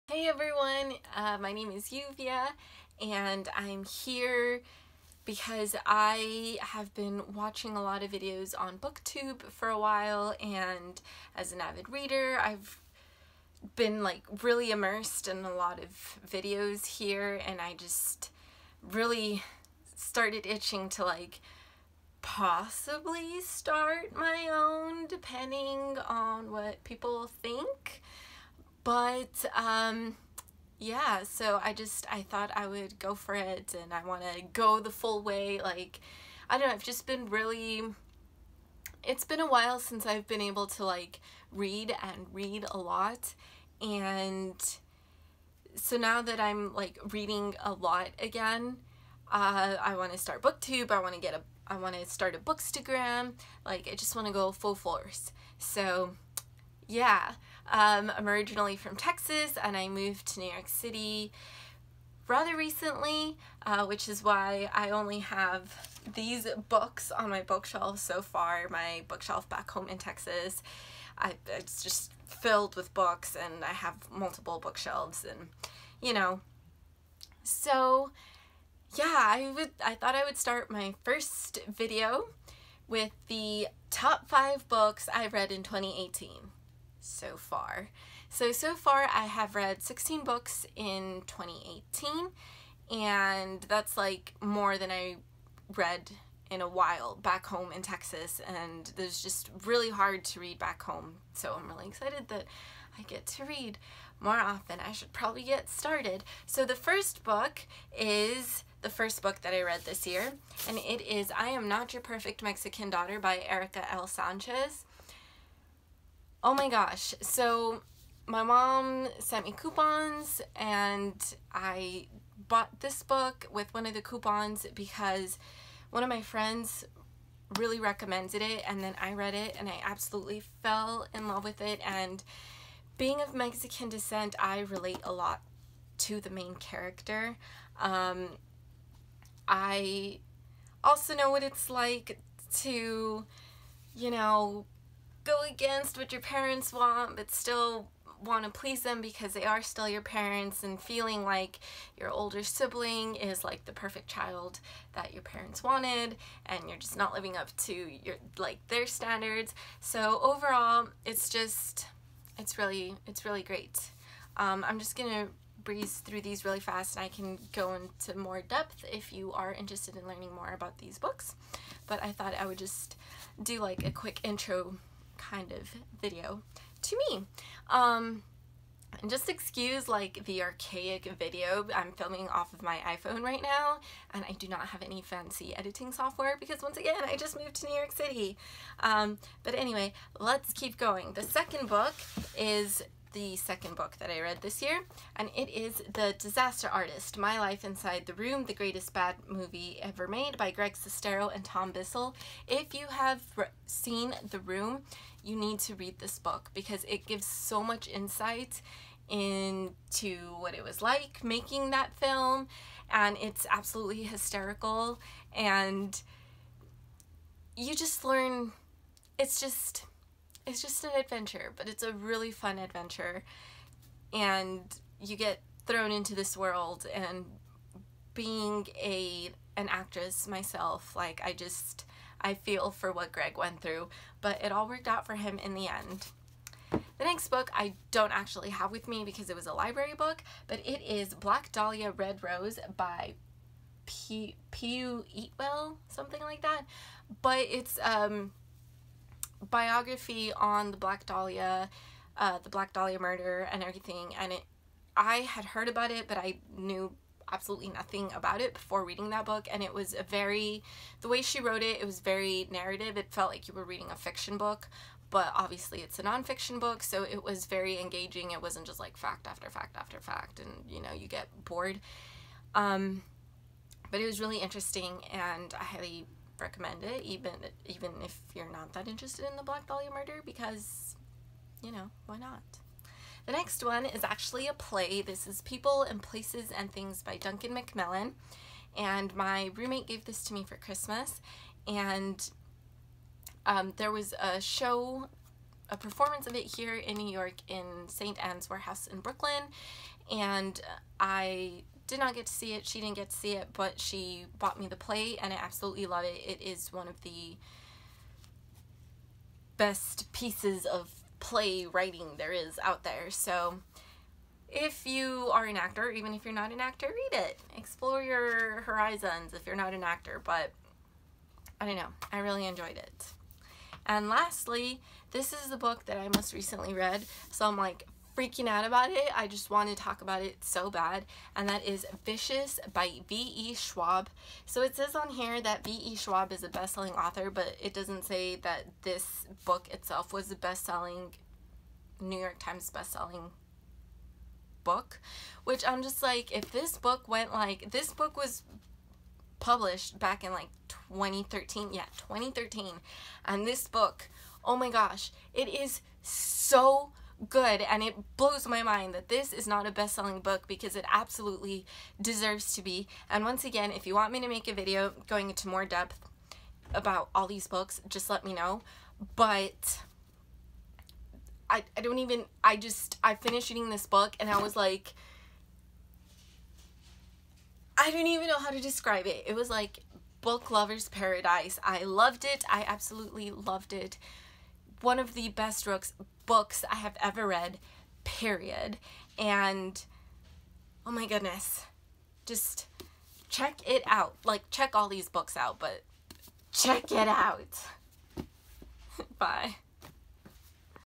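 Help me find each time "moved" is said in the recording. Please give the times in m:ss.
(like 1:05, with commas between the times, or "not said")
0:59, 3:07.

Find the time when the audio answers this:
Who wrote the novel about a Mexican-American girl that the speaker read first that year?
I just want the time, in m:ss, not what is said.
1:53.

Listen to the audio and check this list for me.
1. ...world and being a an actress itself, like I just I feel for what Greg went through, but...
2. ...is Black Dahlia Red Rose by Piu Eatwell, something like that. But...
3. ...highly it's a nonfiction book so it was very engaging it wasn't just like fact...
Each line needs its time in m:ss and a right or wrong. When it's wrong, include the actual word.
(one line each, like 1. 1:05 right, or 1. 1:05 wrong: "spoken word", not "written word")
1. 3:46 wrong: "myself", not "itself"
2. 4:00 right
3. 4:25 wrong: "obviously", not "highly".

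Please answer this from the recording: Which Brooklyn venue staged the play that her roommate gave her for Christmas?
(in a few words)
St. Anne's Warehouse.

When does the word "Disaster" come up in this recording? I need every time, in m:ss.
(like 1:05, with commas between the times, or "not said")
3:16.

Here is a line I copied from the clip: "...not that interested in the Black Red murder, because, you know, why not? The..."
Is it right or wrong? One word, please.
wrong.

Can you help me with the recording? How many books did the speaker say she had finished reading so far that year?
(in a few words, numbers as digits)
16.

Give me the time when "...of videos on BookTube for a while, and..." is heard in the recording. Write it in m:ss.
0:08.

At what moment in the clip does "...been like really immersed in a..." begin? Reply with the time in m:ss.
0:13.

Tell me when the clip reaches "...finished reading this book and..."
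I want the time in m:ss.
6:13.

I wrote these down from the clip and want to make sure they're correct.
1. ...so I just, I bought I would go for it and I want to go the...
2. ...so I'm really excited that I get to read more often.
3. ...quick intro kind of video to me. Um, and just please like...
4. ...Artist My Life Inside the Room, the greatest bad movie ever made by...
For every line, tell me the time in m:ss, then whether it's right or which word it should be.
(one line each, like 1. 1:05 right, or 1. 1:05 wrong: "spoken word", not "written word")
1. 0:31 wrong: "thought", not "bought"
2. 1:41 right
3. 2:53 wrong: "excuse", not "please"
4. 3:16 right.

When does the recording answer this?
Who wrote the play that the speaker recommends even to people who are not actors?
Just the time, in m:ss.
4:47.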